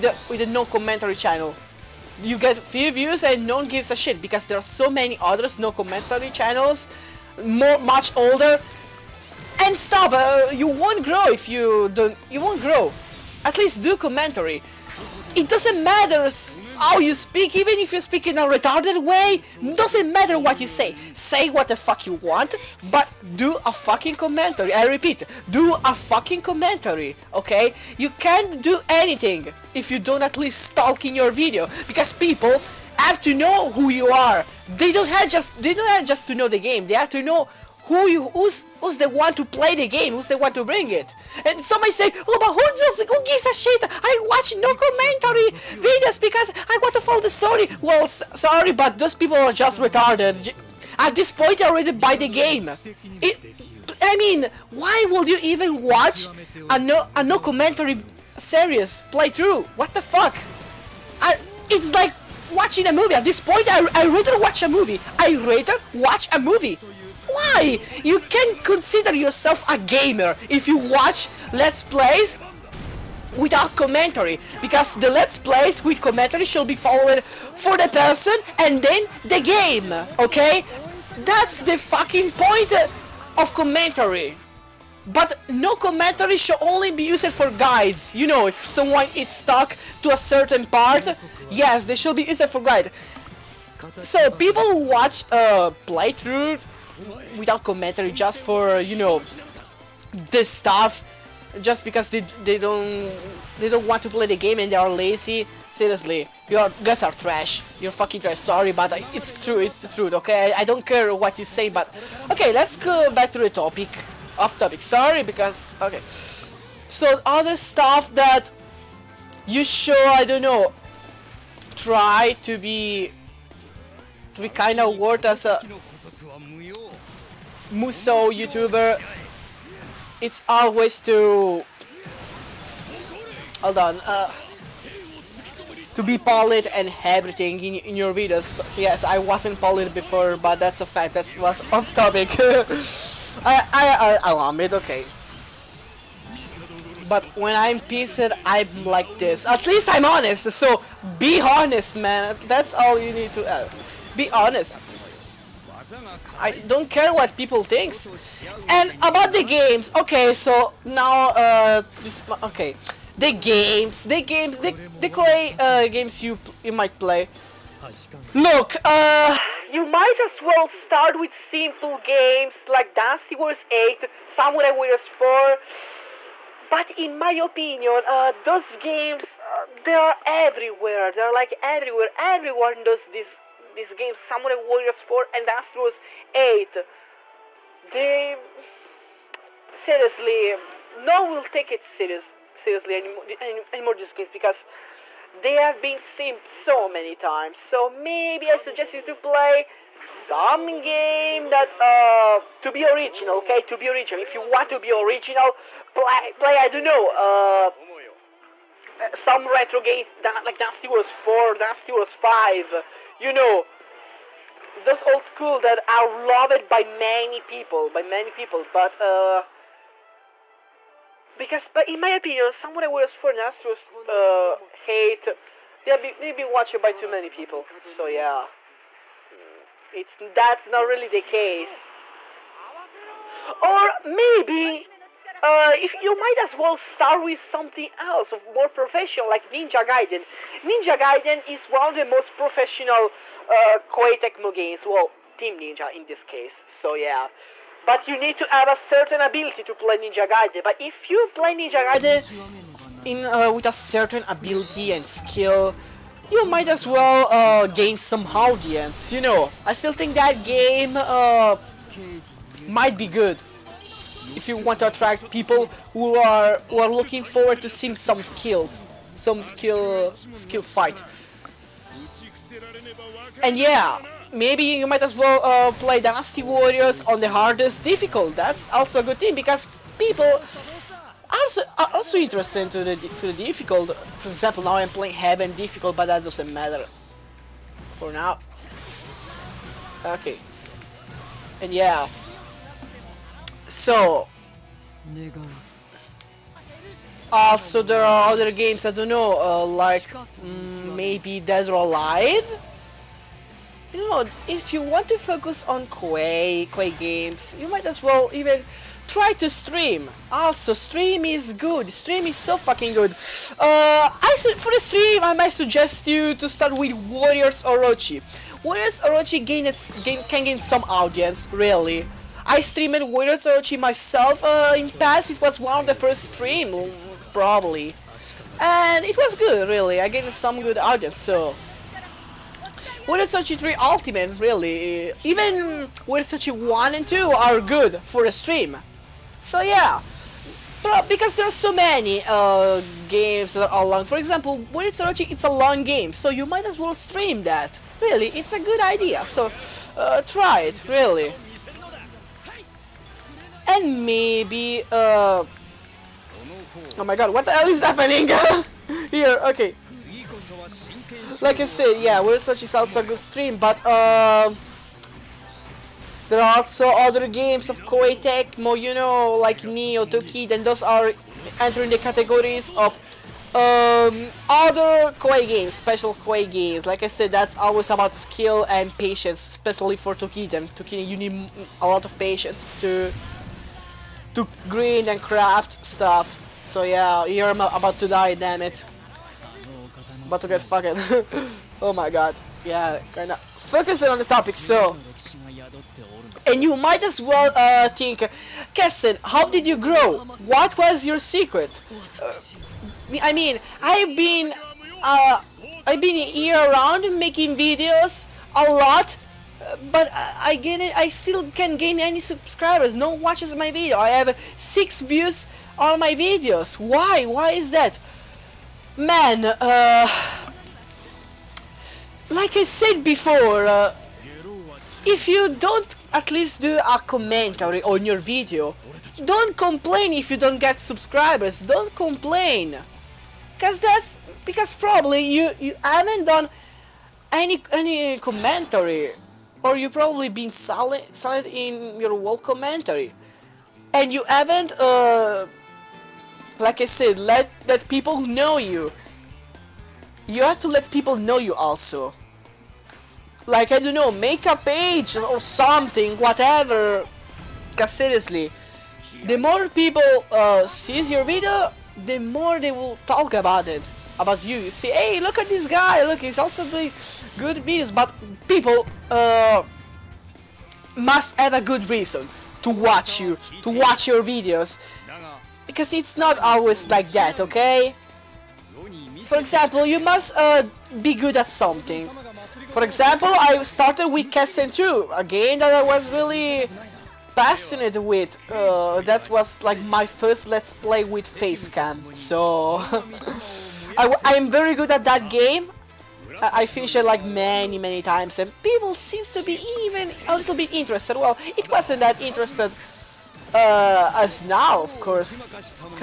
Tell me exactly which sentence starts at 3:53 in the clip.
Or maybe uh, if you might as well start with something else more professional, like Ninja Gaiden.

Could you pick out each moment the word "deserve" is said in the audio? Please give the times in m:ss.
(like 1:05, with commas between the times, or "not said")
not said.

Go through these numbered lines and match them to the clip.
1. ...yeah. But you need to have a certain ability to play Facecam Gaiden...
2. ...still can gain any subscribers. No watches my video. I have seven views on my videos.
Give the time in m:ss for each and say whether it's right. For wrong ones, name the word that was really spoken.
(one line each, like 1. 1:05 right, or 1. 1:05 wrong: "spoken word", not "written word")
1. 4:06 wrong: "Ninja", not "Facecam"
2. 6:51 wrong: "six", not "seven".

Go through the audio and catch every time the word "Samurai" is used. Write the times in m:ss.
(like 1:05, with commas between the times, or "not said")
2:54, 3:04, 3:42.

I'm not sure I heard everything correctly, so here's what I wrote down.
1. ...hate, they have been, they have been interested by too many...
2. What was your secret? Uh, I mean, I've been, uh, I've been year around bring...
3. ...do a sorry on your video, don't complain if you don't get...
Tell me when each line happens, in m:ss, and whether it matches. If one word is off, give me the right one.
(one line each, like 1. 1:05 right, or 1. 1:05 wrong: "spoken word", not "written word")
1. 3:44 wrong: "watched", not "interested"
2. 6:40 wrong: "making", not "bring"
3. 7:06 wrong: "commentary", not "sorry".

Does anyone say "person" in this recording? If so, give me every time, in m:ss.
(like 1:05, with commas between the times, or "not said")
1:17.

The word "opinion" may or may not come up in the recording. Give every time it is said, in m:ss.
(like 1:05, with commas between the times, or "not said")
2:57, 3:42.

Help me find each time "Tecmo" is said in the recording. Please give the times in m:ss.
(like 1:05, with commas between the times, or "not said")
4:04, 6:08.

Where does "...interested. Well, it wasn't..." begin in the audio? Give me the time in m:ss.
8:20.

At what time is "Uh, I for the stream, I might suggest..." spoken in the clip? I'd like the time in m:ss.
5:13.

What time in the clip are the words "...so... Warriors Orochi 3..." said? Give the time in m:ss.
5:31.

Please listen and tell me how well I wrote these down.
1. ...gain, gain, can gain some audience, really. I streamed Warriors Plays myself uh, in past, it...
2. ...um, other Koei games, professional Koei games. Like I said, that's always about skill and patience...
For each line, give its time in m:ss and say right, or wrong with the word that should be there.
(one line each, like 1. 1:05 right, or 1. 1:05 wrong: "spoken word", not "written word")
1. 5:19 wrong: "Orochi", not "Plays"
2. 6:13 wrong: "special", not "professional".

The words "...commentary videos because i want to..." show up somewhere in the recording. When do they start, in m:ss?
0:44.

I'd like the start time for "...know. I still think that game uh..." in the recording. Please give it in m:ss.
4:19.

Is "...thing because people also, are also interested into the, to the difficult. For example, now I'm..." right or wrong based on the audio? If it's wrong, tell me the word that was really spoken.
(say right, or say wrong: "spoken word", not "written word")
right.